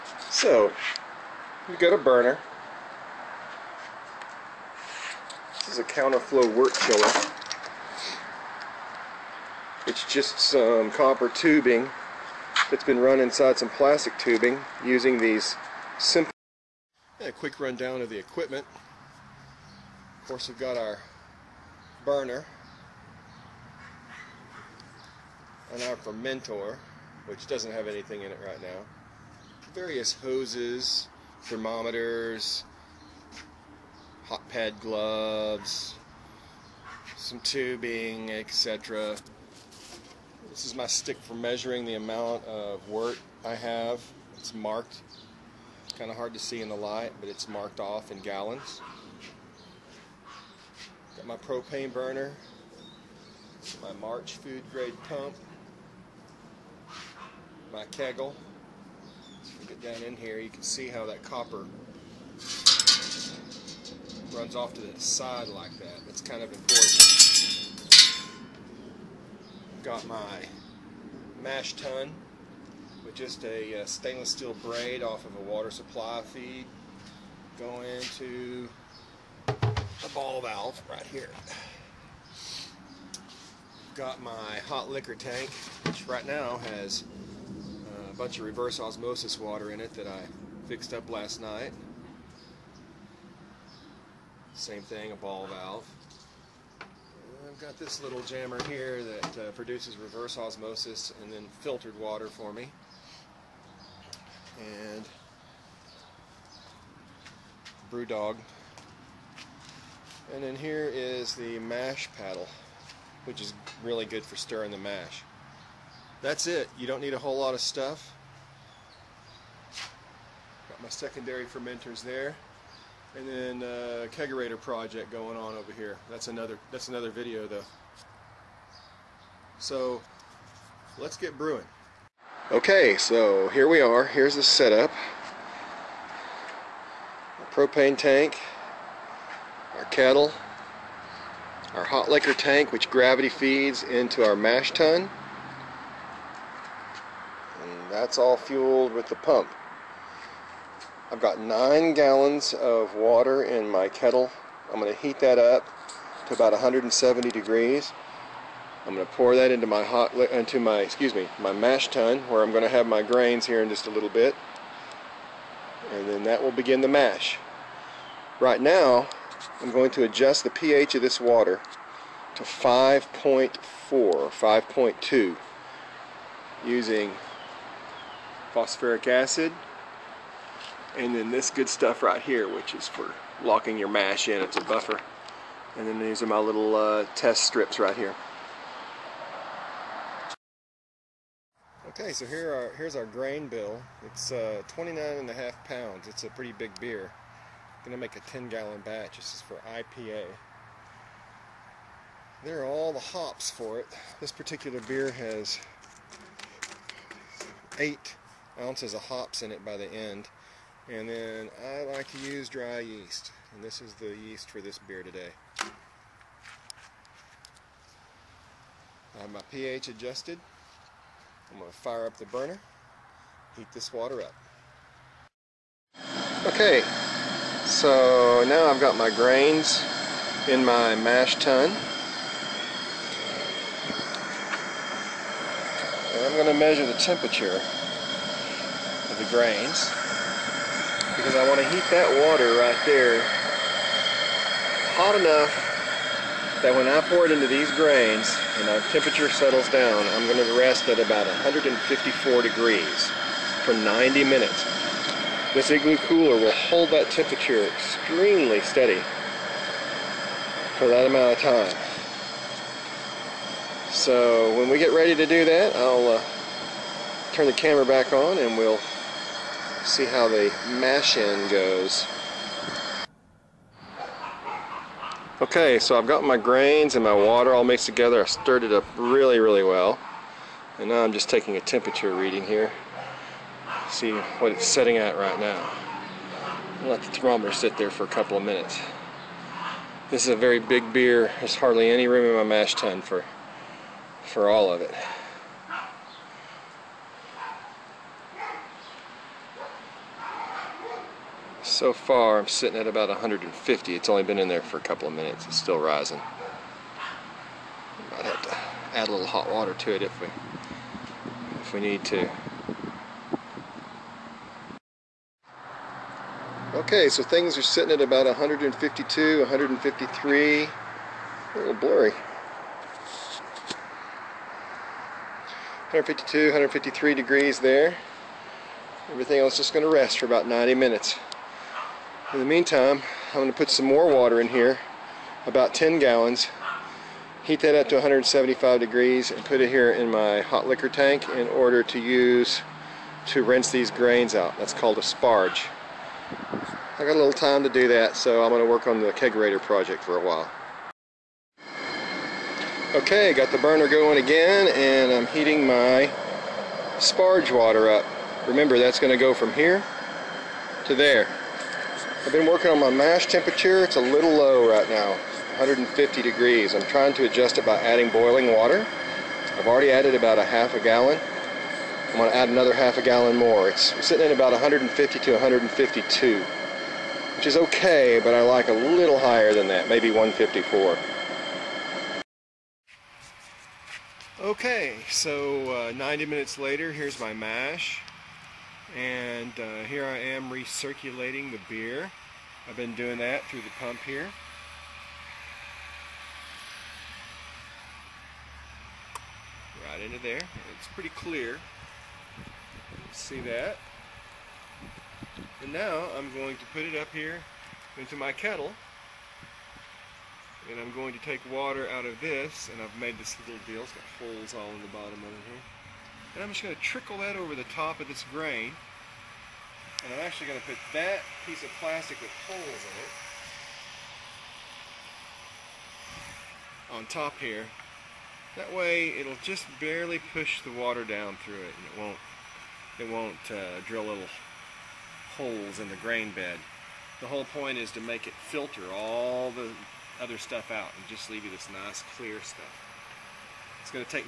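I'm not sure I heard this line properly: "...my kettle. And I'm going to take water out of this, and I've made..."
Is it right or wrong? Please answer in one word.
right.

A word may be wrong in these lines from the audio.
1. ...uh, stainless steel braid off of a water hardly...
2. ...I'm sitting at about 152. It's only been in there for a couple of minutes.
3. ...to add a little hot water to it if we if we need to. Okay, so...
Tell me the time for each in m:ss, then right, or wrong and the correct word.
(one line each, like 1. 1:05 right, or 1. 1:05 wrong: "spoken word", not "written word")
1. 1:13 wrong: "supply", not "hardly"
2. 5:02 wrong: "150", not "152"
3. 5:08 right.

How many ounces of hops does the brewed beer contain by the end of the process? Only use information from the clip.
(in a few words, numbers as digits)
8 ounces.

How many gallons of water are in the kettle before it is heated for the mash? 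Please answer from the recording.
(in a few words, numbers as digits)
9 gallons.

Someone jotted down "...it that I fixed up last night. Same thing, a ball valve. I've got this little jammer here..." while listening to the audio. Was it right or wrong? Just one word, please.
right.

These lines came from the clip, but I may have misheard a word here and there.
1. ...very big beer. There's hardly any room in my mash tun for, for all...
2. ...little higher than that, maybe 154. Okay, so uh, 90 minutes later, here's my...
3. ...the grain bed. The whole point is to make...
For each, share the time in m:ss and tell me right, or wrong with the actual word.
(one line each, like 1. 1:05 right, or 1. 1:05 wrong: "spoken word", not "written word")
1. 4:50 right
2. 6:18 right
3. 7:15 right.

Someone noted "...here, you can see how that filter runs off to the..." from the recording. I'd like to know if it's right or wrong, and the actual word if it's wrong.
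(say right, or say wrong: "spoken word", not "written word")
wrong: "copper", not "filter".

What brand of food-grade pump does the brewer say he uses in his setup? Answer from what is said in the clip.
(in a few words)
March.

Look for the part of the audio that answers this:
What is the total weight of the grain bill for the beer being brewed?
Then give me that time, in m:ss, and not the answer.
3:14.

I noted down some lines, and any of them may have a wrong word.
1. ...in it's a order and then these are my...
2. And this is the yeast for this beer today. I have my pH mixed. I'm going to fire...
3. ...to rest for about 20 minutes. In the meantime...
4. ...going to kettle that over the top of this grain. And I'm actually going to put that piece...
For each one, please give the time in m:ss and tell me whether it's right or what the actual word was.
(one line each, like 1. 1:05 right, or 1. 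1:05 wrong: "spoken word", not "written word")
1. 3:04 wrong: "buffer", not "order"
2. 3:33 wrong: "adjusted", not "mixed"
3. 5:29 wrong: "90", not "20"
4. 6:56 wrong: "trickle", not "kettle".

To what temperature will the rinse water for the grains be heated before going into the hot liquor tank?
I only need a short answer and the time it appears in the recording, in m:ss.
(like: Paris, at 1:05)
175 degrees, at 5:37.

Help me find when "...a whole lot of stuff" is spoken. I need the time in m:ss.
1:57.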